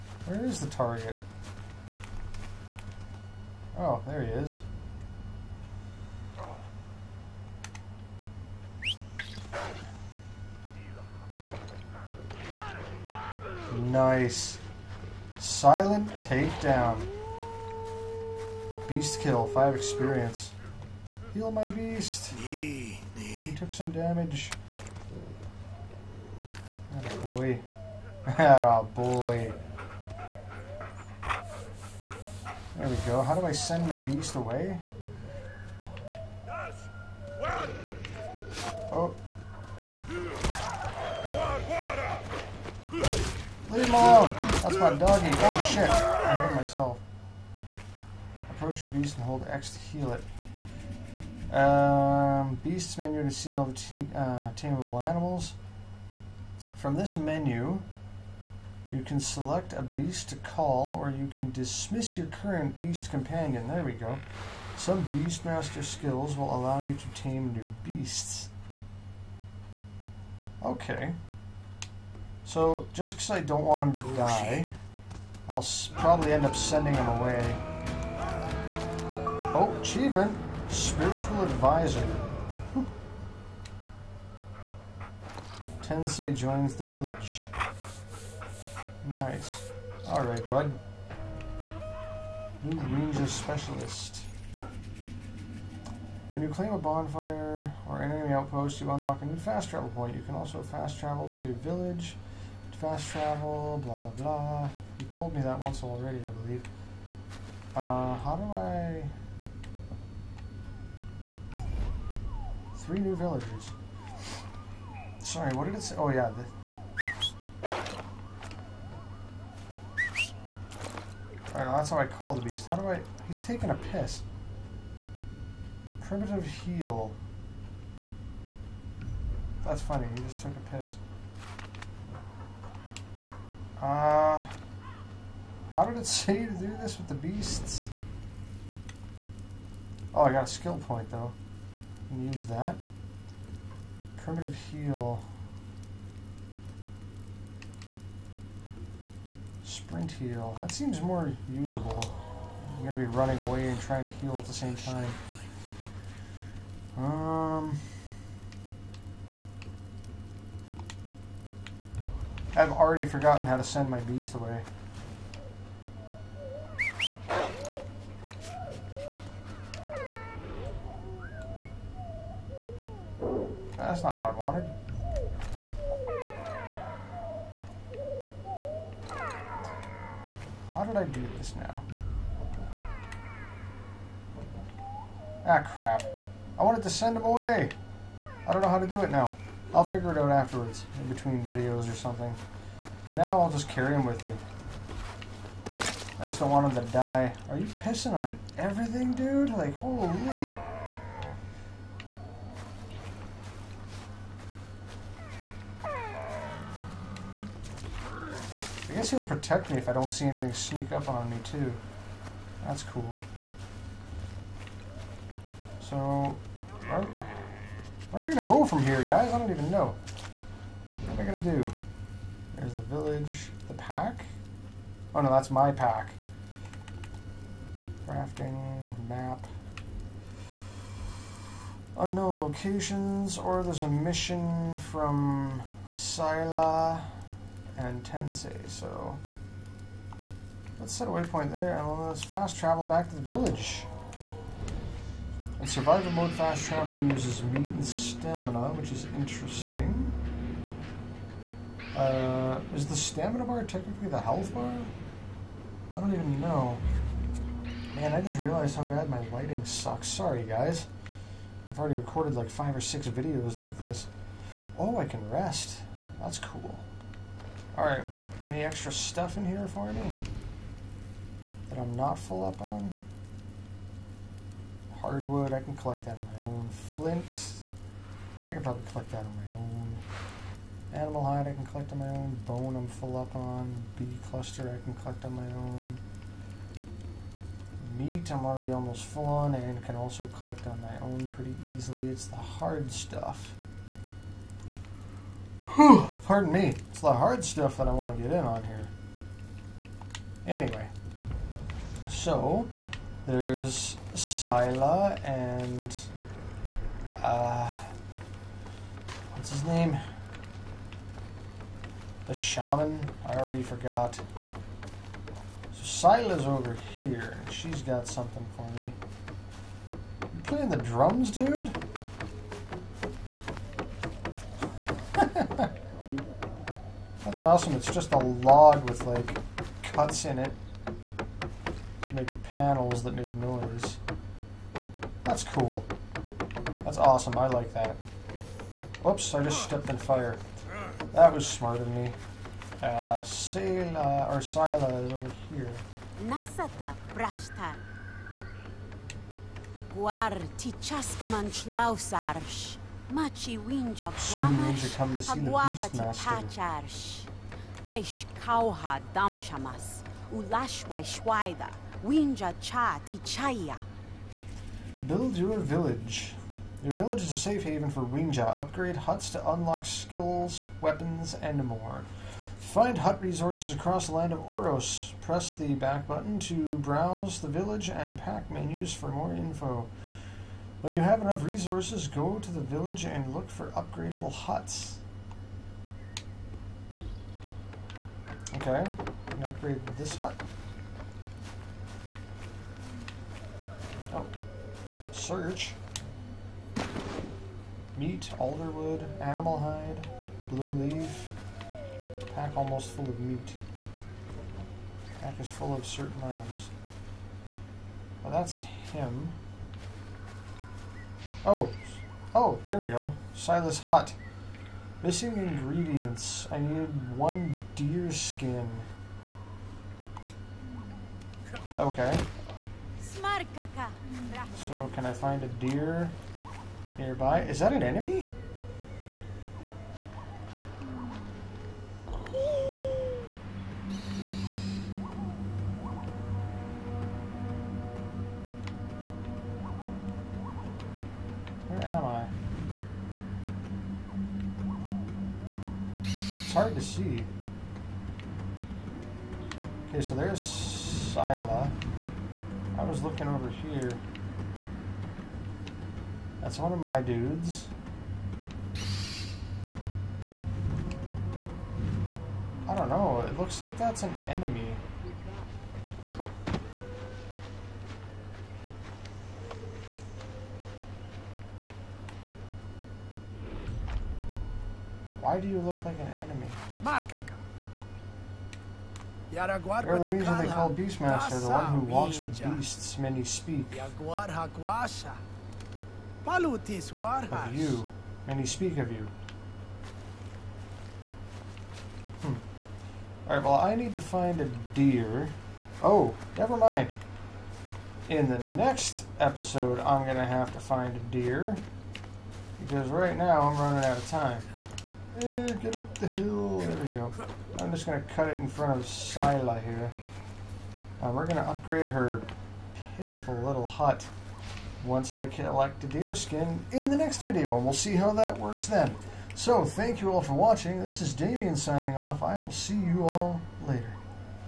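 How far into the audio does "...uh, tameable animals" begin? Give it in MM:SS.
00:54.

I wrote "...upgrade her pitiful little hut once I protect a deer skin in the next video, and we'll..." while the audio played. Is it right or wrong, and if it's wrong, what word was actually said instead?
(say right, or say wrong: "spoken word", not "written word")
wrong: "collect", not "protect".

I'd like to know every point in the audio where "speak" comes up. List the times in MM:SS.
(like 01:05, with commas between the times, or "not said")
08:03, 08:08.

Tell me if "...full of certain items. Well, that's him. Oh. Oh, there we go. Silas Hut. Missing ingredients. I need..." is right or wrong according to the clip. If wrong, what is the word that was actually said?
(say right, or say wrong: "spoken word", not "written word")
right.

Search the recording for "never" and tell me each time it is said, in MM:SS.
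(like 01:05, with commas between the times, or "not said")
08:16.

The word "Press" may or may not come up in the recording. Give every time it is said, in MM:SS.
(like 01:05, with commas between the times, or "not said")
06:15.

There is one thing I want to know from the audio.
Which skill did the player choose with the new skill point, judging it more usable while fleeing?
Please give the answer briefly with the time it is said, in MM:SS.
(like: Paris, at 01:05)
Sprint heal, at 02:29.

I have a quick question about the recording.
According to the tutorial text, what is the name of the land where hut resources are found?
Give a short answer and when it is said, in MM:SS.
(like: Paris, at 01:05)
Oros, at 06:14.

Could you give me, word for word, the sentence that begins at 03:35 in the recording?
So, where am I gonna go from here, guys?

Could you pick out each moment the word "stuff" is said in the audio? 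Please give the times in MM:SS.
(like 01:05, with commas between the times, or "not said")
04:28, 04:52, 04:57.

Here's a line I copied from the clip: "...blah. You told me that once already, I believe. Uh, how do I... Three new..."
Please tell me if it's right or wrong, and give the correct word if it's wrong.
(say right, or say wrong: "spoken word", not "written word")
right.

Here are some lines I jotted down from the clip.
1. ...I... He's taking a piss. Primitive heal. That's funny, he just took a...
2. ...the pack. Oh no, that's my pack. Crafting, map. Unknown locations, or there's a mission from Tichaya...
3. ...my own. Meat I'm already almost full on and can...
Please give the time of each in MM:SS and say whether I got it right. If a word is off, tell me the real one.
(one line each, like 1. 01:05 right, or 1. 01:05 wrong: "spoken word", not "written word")
1. 02:02 right
2. 03:43 wrong: "Sila", not "Tichaya"
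3. 04:45 right.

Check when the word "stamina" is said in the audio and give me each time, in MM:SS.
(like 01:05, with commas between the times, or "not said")
04:07, 04:12.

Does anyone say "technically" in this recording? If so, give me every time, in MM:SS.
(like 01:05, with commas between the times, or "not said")
04:13.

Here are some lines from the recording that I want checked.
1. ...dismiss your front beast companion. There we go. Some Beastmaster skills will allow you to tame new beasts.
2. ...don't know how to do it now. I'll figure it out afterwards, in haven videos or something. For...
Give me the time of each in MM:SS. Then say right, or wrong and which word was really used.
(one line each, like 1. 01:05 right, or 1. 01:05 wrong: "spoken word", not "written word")
1. 01:01 wrong: "current", not "front"
2. 03:08 wrong: "between", not "haven".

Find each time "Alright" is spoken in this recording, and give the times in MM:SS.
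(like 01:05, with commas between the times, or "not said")
01:30, 01:56, 04:27, 08:13.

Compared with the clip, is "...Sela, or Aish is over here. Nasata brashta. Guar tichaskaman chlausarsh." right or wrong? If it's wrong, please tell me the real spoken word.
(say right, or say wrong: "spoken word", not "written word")
wrong: "Sila", not "Aish".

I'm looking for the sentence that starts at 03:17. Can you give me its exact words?
Are you pissing on everything, dude?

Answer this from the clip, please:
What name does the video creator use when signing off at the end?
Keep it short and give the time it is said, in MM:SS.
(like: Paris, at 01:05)
Damien, at 08:41.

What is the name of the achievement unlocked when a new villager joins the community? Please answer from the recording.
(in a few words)
Spiritual Advisor.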